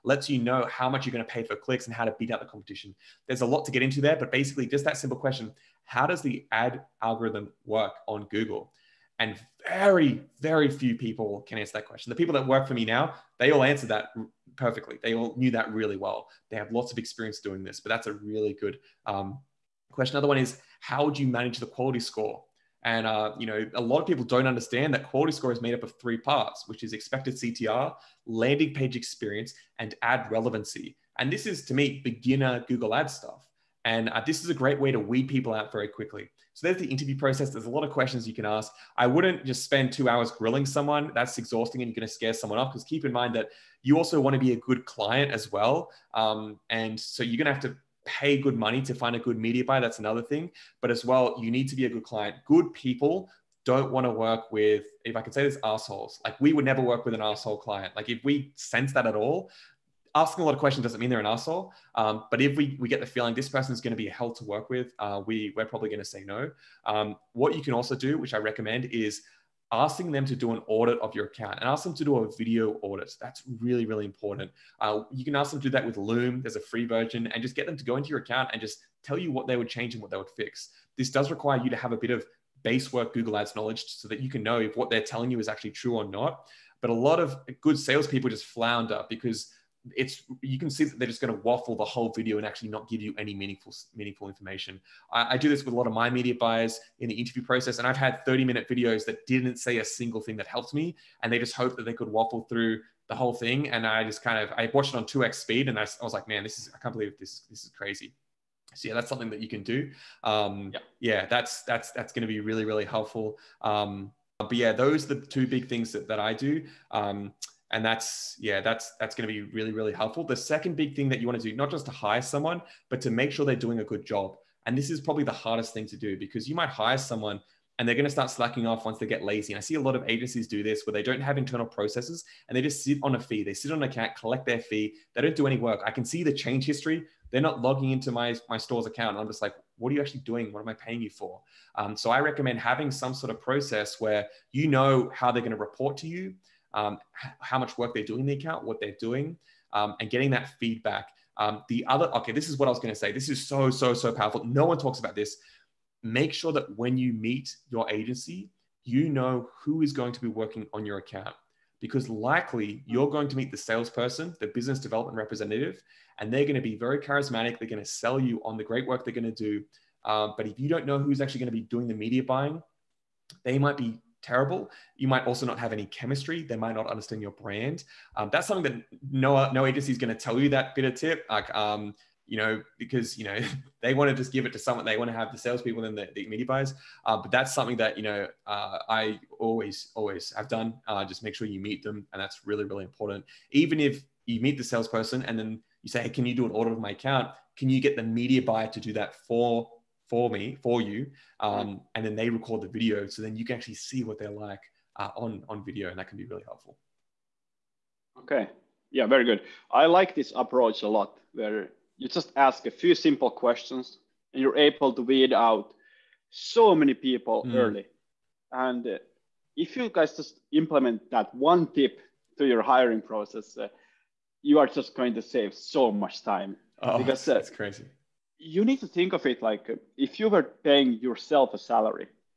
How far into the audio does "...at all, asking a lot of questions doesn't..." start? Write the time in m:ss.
0:59.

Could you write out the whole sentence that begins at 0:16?
They have lots of experience doing this, but that's a really good um, question.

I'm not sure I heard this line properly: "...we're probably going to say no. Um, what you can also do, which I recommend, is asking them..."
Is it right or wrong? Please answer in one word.
right.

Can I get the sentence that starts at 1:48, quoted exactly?
So yeah, that's something that you can do.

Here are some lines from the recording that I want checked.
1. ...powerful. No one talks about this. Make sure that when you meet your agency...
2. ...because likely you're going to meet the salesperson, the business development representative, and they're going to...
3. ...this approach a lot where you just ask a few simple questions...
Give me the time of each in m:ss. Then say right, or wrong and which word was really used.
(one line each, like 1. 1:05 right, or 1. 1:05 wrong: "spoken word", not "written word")
1. 2:34 right
2. 2:41 right
3. 3:30 right.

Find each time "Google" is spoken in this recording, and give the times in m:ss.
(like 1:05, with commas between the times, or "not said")
0:08, 0:32, 1:23.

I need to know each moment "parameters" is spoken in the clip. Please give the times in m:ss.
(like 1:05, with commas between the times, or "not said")
not said.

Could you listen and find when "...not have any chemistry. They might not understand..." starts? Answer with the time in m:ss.
2:55.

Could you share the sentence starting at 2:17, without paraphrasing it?
They're not logging into my, my store's account.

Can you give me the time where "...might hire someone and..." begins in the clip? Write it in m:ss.
2:06.